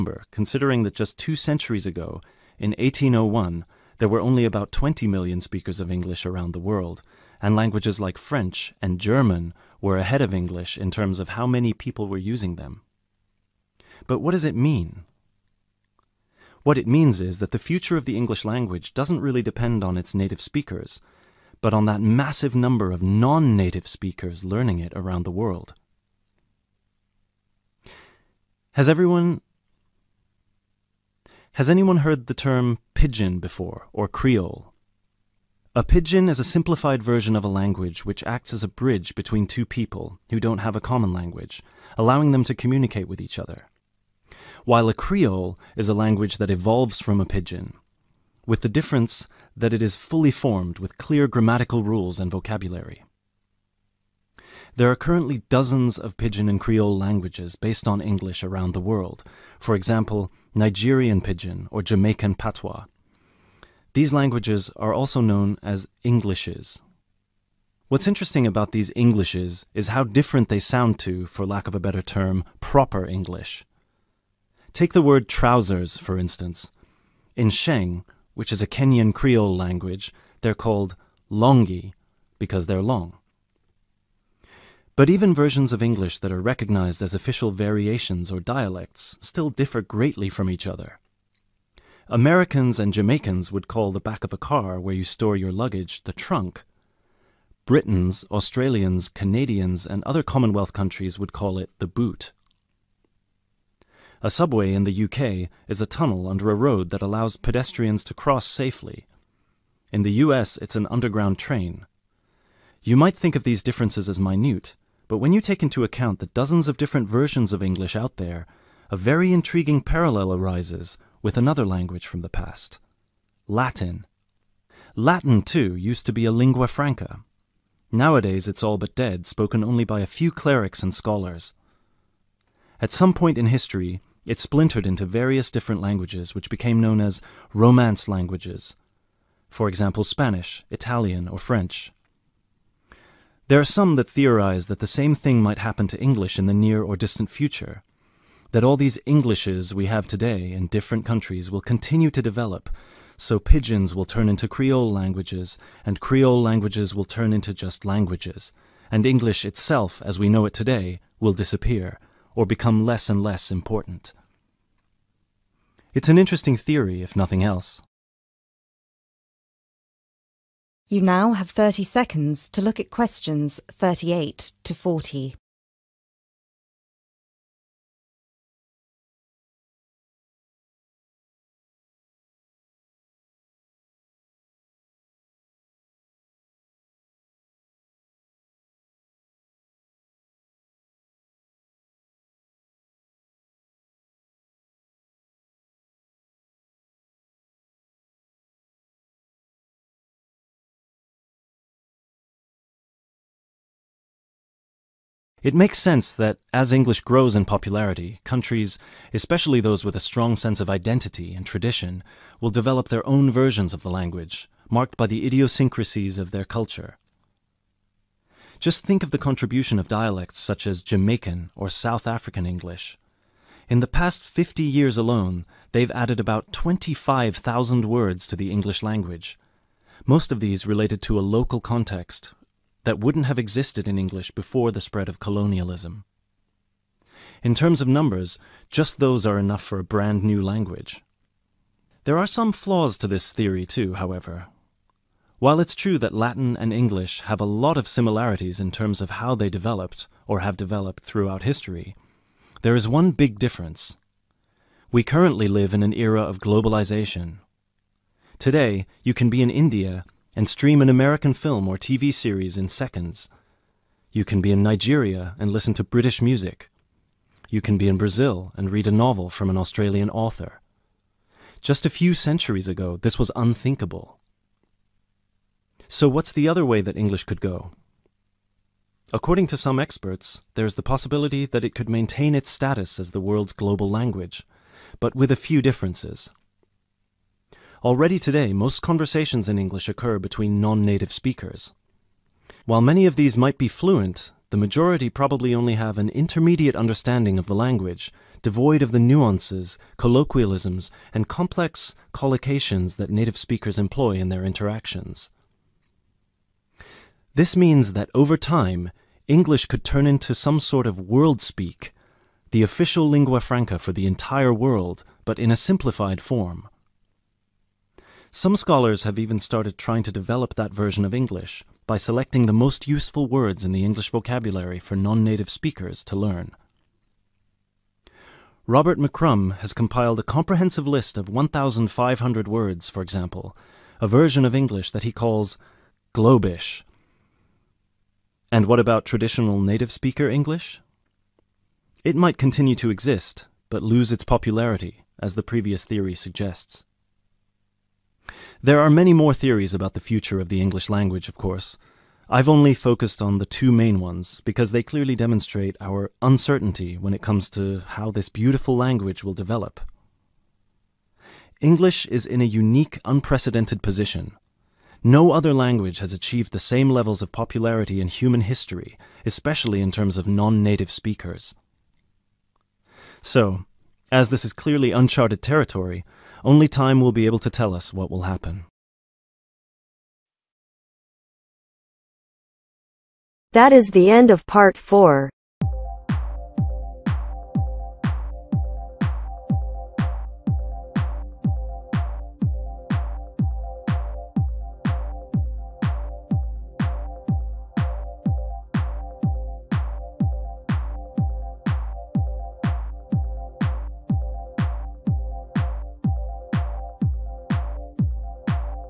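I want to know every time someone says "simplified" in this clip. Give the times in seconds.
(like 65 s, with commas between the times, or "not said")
36 s, 315 s.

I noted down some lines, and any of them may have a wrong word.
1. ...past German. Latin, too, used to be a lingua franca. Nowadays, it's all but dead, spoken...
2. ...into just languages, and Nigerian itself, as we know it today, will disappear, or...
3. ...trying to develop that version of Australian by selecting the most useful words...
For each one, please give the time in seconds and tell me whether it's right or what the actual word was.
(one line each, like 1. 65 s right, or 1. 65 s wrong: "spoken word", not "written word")
1. 122 s wrong: "Latin", not "German"
2. 157 s wrong: "English", not "Nigerian"
3. 319 s wrong: "English", not "Australian".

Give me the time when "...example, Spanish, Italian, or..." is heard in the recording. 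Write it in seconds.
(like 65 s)
139 s.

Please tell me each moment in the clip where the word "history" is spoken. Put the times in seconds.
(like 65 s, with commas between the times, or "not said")
133 s, 251 s, 368 s.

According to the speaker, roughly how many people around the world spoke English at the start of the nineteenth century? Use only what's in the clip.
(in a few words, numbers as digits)
20 million.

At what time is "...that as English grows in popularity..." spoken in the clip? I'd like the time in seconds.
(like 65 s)
206 s.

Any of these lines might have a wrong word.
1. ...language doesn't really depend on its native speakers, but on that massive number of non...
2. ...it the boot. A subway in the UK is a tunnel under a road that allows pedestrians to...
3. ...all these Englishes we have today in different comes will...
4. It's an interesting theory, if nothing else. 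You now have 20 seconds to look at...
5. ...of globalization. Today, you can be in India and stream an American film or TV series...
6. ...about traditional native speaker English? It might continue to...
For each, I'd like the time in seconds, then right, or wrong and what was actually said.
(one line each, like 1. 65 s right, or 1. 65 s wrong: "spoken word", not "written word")
1. 18 s right
2. 101 s right
3. 148 s wrong: "countries", not "comes"
4. 165 s wrong: "30", not "20"
5. 256 s right
6. 338 s right.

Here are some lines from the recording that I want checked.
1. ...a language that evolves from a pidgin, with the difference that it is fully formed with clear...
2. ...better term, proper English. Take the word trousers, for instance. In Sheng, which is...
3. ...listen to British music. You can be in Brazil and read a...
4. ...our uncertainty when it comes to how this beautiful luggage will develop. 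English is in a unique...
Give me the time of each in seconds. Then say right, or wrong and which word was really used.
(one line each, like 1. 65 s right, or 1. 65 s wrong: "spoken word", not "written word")
1. 45 s right
2. 71 s right
3. 265 s right
4. 355 s wrong: "language", not "luggage".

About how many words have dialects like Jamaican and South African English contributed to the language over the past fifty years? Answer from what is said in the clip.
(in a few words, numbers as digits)
25,000.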